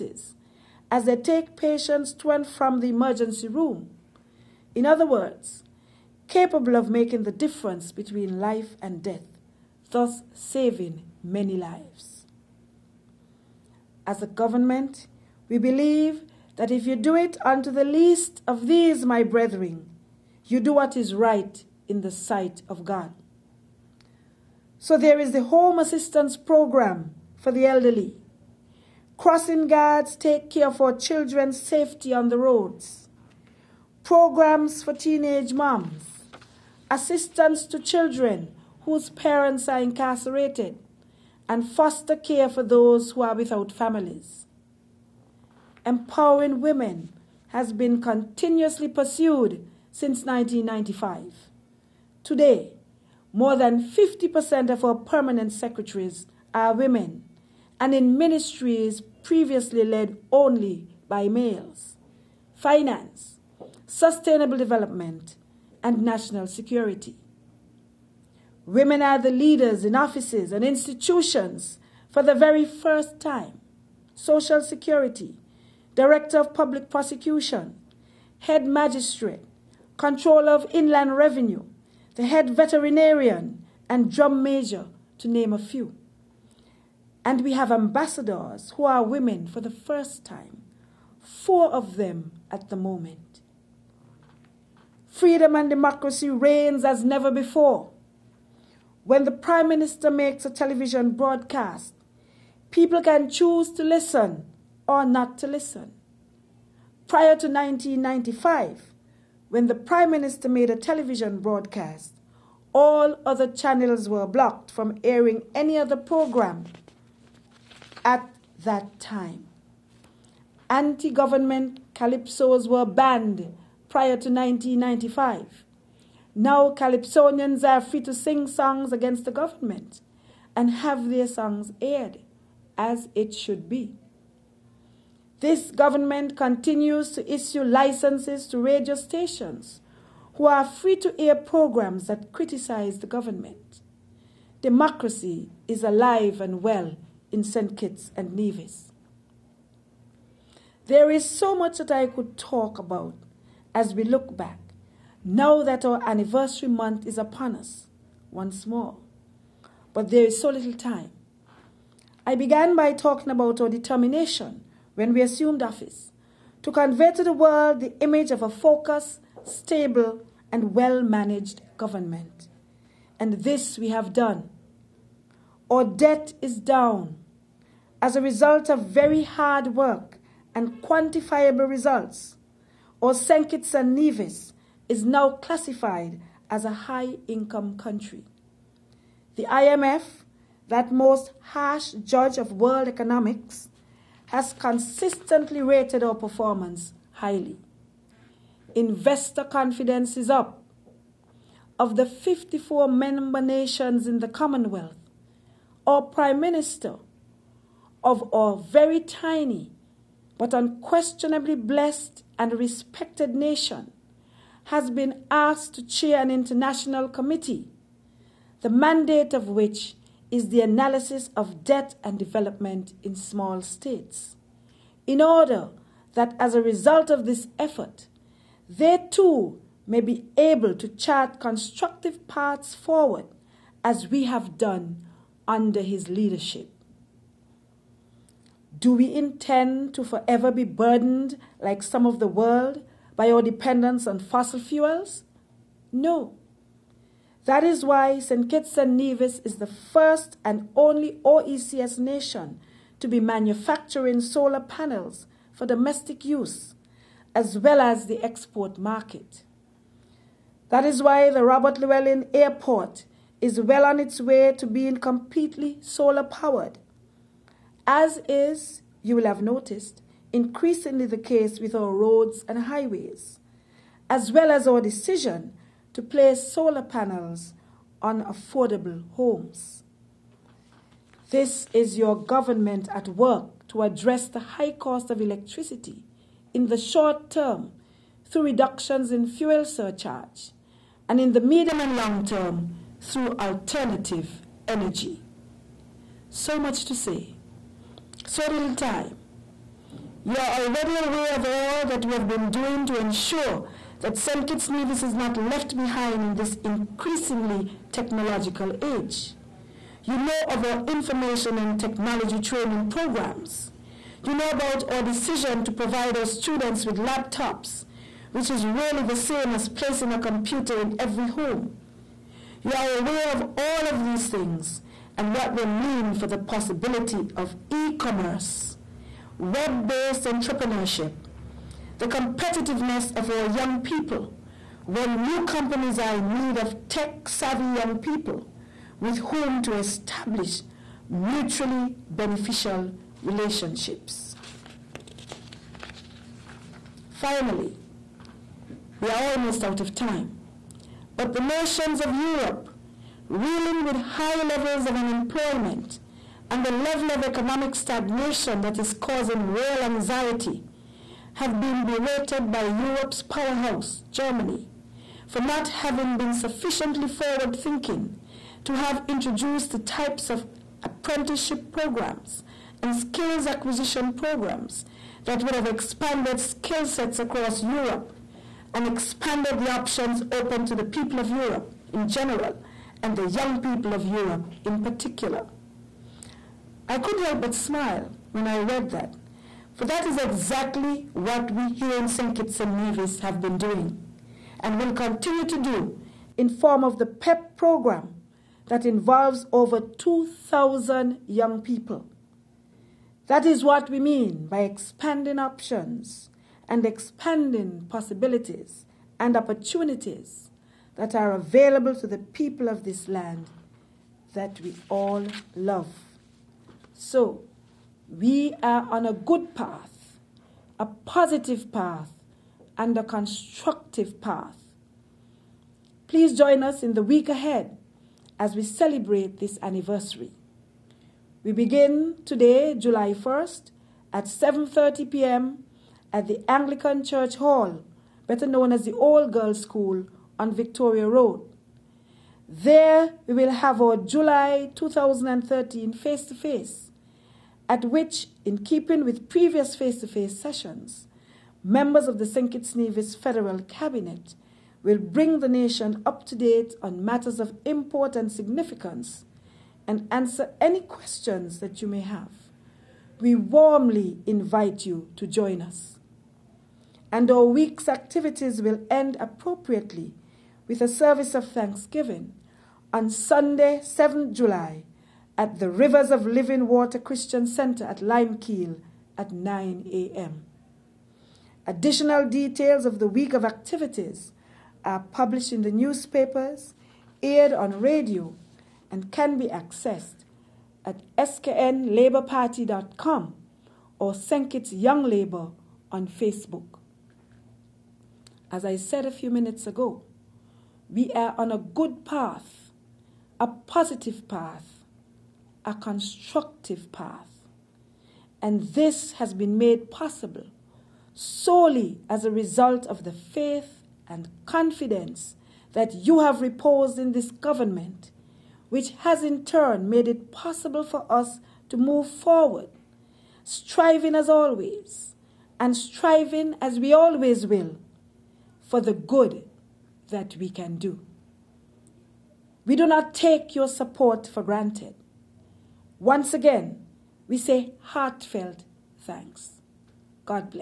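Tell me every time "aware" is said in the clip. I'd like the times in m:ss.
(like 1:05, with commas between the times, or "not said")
5:00, 5:22.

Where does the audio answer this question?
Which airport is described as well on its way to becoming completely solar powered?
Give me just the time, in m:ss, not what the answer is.
4:21.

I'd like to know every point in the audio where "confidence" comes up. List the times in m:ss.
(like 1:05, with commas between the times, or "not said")
3:19, 8:34.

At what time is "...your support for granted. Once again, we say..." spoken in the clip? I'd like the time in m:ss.
8:53.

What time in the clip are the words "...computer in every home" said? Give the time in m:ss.
5:20.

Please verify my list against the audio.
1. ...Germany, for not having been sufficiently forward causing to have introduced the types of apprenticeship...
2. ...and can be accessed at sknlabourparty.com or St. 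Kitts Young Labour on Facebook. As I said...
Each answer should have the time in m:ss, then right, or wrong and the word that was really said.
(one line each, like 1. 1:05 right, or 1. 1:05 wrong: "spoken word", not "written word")
1. 6:04 wrong: "thinking", not "causing"
2. 8:08 right.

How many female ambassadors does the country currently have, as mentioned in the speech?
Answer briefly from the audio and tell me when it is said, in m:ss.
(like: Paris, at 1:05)
4, at 1:31.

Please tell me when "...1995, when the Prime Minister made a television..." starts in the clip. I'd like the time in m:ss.
1:47.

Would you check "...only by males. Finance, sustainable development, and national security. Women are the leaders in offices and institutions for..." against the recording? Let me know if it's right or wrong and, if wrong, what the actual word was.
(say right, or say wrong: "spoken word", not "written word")
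right.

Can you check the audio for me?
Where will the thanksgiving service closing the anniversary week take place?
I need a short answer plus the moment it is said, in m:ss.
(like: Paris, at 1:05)
Rivers of Living Water Christian Center, at 7:55.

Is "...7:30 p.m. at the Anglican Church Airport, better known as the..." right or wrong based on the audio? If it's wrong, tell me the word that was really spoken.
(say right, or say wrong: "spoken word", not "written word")
wrong: "Hall", not "Airport".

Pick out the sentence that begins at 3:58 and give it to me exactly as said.
Do we intend to forever be burdened, like some of the world, by our dependence on fossil fuels?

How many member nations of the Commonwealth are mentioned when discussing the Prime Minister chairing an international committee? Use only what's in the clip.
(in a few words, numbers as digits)
54.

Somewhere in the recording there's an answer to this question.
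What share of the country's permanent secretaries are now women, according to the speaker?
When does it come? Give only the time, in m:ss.
0:53.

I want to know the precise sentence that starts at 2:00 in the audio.
Anti government calypsos were banned prior to 1995.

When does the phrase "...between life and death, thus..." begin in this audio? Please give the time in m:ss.
0:07.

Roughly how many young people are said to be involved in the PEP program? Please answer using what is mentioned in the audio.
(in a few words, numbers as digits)
Over 2,000.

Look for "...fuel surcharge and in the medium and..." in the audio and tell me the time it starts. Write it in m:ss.
4:49.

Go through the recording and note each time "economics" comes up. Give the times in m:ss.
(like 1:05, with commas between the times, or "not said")
3:12, 5:57.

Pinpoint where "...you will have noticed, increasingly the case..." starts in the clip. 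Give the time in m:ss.
4:29.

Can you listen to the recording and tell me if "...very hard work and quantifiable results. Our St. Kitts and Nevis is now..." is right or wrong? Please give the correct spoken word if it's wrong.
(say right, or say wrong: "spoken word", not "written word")
right.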